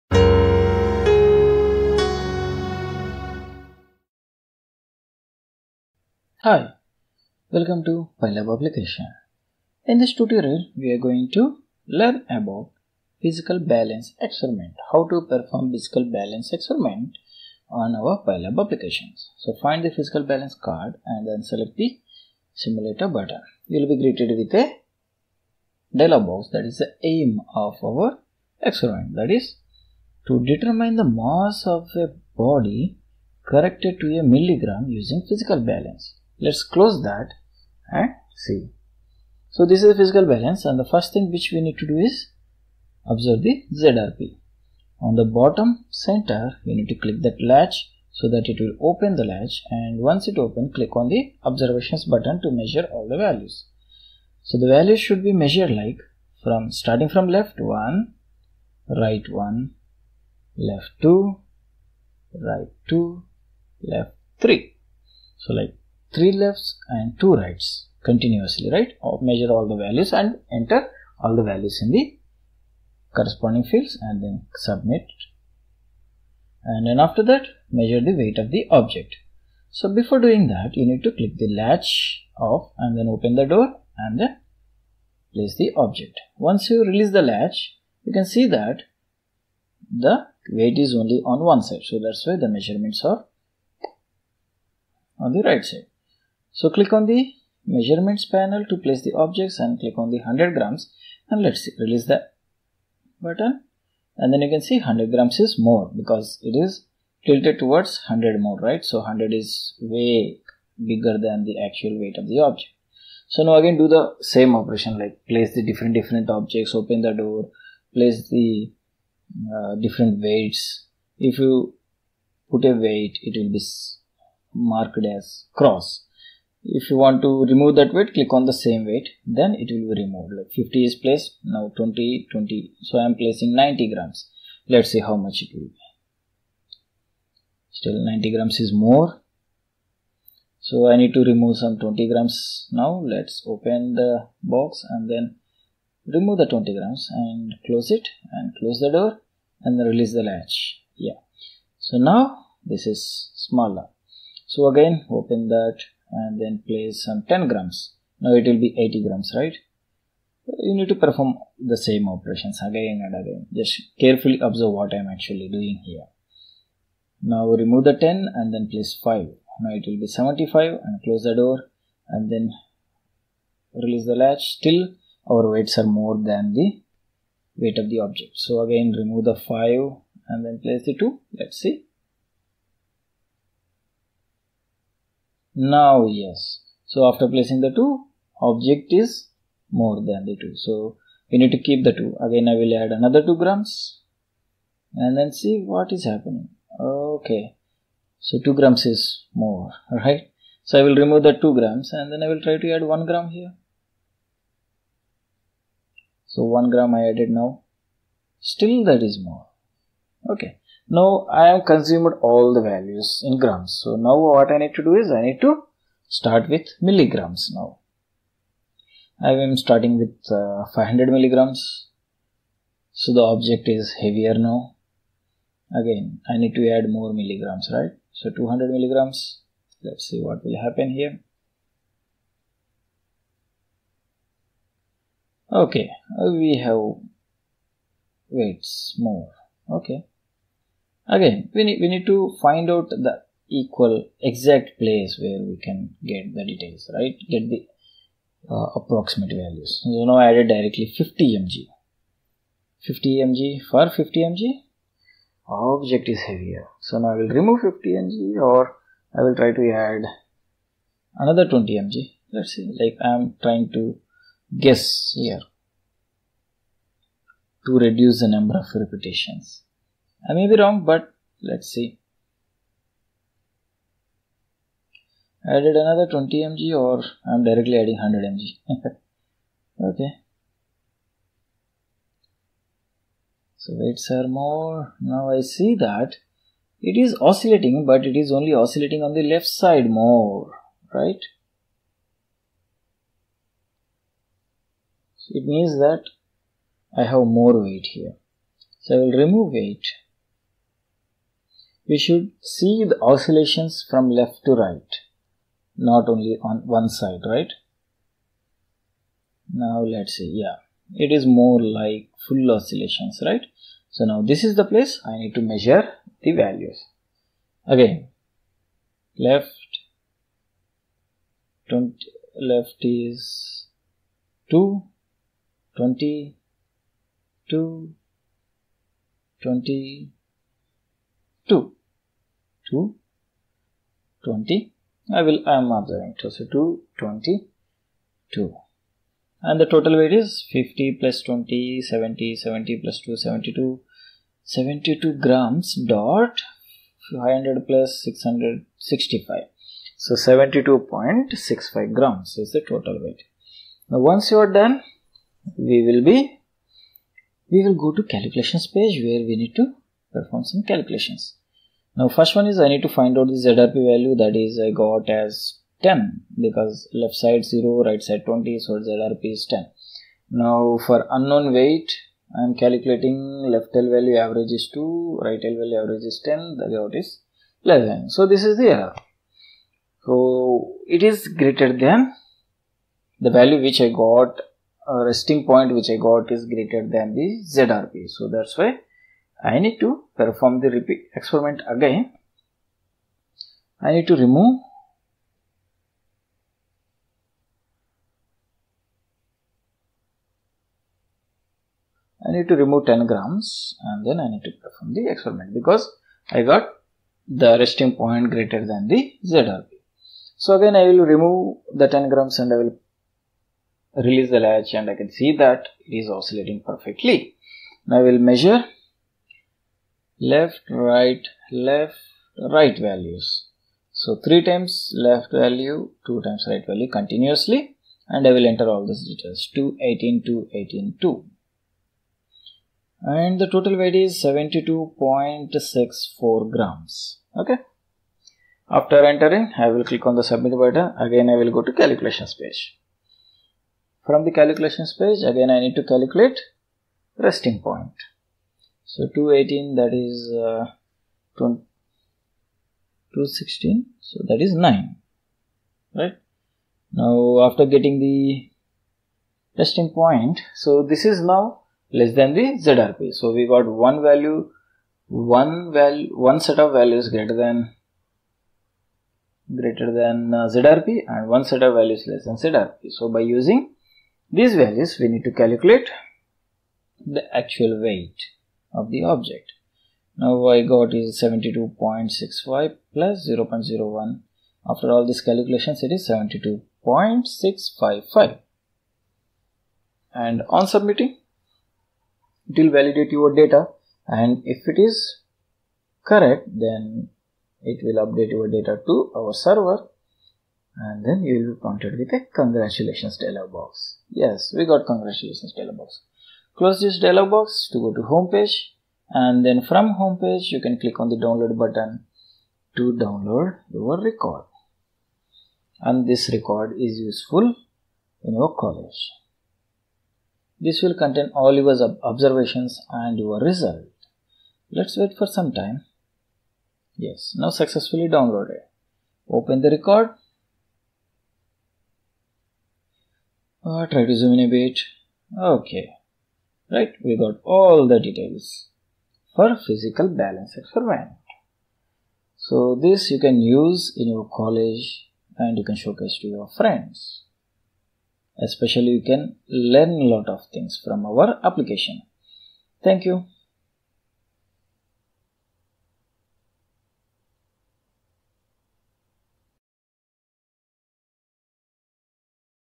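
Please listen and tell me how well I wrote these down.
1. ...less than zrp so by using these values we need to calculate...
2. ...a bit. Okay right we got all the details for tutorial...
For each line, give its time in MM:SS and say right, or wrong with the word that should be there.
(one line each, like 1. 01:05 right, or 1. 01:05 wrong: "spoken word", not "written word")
1. 07:52 right
2. 08:54 wrong: "physical", not "tutorial".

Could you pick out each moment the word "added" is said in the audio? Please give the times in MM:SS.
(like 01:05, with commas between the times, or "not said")
03:27, 04:10, 04:35.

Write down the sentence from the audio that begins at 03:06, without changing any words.
So after placing the 2, object is more than the 2.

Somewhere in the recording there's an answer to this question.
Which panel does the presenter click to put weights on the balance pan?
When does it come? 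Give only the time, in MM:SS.
01:37.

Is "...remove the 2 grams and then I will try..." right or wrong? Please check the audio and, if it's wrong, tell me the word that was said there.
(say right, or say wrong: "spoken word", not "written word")
right.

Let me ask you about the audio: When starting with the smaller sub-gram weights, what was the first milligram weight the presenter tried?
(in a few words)
500 milligrams.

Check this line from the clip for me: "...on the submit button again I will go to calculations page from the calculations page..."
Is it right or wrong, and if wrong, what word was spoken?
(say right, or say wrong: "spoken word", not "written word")
right.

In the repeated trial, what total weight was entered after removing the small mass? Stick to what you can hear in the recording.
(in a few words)
72.64 grams.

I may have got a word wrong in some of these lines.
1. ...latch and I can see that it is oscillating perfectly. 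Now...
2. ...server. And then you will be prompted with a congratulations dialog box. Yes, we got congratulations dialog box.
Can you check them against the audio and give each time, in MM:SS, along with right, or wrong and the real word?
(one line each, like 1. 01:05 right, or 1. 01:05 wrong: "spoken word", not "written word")
1. 06:54 right
2. 08:19 right.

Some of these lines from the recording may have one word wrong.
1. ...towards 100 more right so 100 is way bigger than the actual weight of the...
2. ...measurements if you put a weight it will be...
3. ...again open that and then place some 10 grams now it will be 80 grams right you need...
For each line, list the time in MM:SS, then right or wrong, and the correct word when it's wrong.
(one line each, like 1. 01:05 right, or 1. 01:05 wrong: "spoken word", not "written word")
1. 01:47 right
2. 02:00 wrong: "weights", not "measurements"
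3. 02:34 right.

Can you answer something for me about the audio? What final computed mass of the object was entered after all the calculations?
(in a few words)
72.655.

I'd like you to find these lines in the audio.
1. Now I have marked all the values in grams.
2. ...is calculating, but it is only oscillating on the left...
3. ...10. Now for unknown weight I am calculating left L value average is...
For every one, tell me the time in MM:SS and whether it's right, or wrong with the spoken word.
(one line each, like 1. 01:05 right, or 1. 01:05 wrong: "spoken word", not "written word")
1. 03:30 wrong: "consumed", not "marked"
2. 04:46 wrong: "oscillating", not "calculating"
3. 06:09 right.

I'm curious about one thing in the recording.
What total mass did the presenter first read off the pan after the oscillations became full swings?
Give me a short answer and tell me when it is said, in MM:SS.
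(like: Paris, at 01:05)
72.65 grams, at 05:50.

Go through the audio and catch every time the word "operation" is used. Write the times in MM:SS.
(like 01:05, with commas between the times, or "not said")
01:54, 02:42.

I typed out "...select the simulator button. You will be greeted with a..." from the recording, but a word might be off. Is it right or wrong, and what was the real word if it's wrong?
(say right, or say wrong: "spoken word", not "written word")
right.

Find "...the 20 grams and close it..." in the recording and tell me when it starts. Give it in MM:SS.
02:26.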